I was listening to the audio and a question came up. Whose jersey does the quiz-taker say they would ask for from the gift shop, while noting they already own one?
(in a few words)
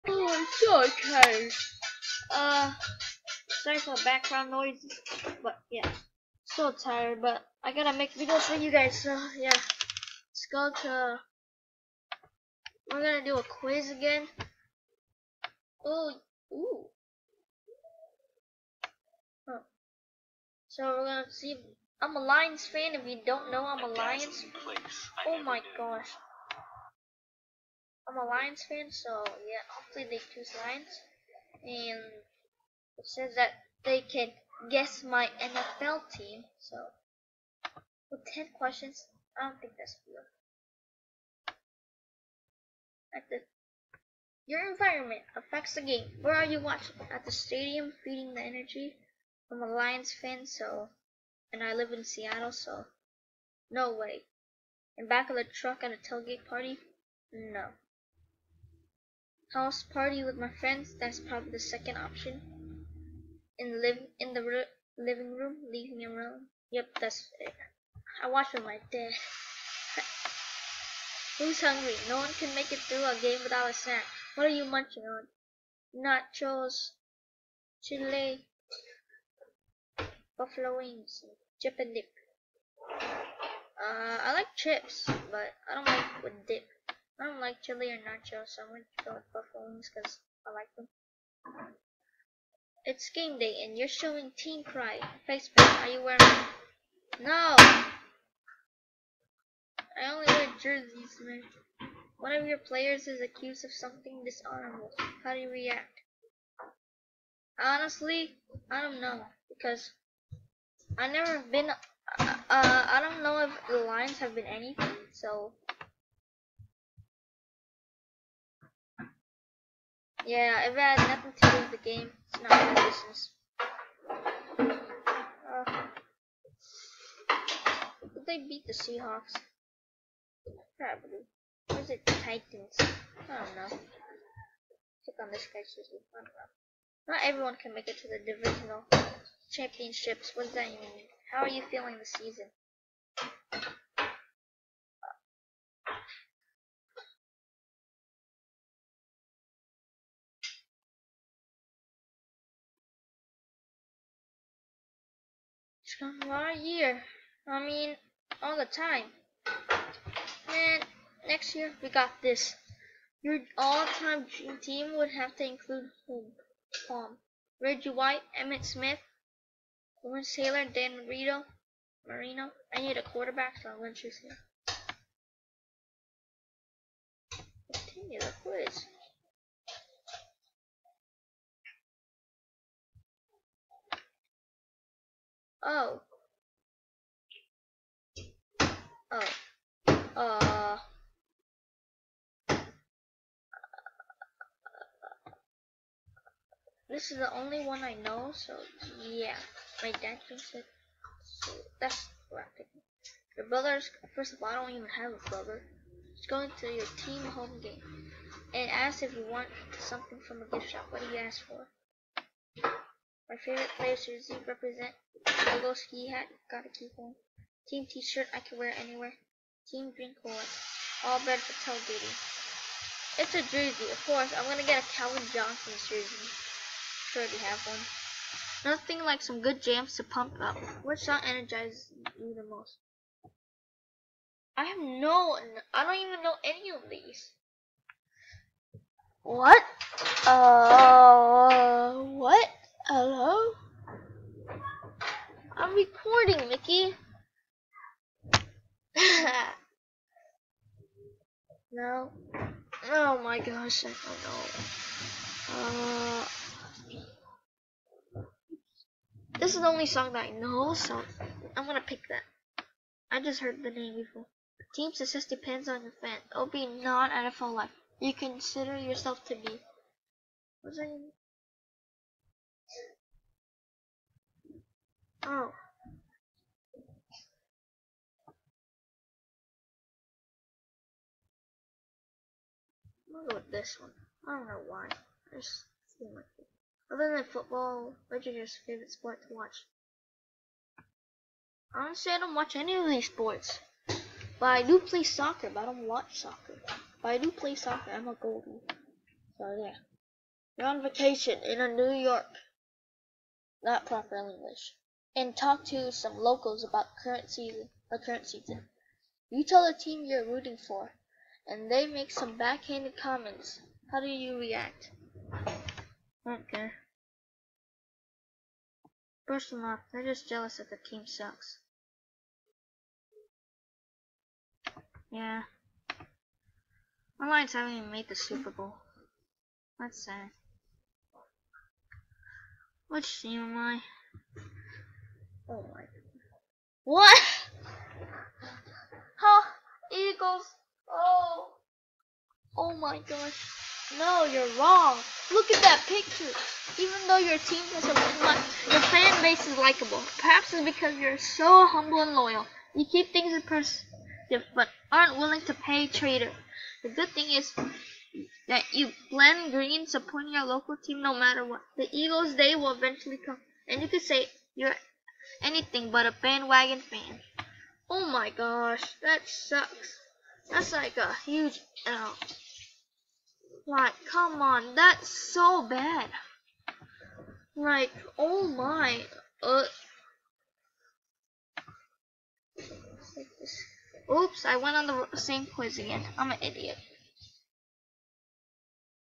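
Calvin Johnson.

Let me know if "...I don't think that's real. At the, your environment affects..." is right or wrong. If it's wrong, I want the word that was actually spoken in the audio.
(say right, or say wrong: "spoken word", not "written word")
right.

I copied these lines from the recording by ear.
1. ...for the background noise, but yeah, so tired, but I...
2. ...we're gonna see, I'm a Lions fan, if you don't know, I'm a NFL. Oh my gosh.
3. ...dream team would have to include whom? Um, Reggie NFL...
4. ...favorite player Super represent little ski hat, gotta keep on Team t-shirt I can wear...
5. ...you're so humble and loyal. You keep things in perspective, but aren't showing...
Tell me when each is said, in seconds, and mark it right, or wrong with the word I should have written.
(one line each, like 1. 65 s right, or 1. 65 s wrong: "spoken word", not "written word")
1. 3 s right
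2. 20 s wrong: "Lions", not "NFL"
3. 164 s wrong: "White", not "NFL"
4. 213 s wrong: "Susie", not "Super"
5. 350 s wrong: "willing", not "showing".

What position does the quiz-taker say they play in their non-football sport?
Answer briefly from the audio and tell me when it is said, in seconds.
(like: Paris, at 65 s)
Goalie, at 298 s.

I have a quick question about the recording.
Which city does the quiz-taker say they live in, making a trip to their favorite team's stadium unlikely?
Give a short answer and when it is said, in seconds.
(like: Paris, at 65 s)
Seattle, at 52 s.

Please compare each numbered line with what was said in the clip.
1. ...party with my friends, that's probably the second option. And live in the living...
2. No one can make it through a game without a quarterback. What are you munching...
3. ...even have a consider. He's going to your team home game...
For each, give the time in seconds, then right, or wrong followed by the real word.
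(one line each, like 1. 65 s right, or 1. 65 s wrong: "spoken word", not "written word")
1. 59 s right
2. 72 s wrong: "snack", not "quarterback"
3. 204 s wrong: "brother", not "consider".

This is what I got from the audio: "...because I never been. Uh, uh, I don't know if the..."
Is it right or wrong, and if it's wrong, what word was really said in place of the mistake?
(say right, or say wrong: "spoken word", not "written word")
right.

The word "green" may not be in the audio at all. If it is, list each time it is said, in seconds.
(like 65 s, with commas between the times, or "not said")
219 s, 359 s.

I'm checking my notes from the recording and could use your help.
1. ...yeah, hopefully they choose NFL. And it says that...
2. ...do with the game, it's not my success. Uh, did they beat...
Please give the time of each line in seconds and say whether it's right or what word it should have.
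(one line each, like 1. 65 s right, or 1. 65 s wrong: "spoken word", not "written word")
1. 29 s wrong: "Lions", not "NFL"
2. 121 s wrong: "business", not "success".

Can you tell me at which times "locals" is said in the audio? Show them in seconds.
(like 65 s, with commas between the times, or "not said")
306 s, 360 s.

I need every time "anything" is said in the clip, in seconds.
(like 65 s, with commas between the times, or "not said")
114 s, 365 s.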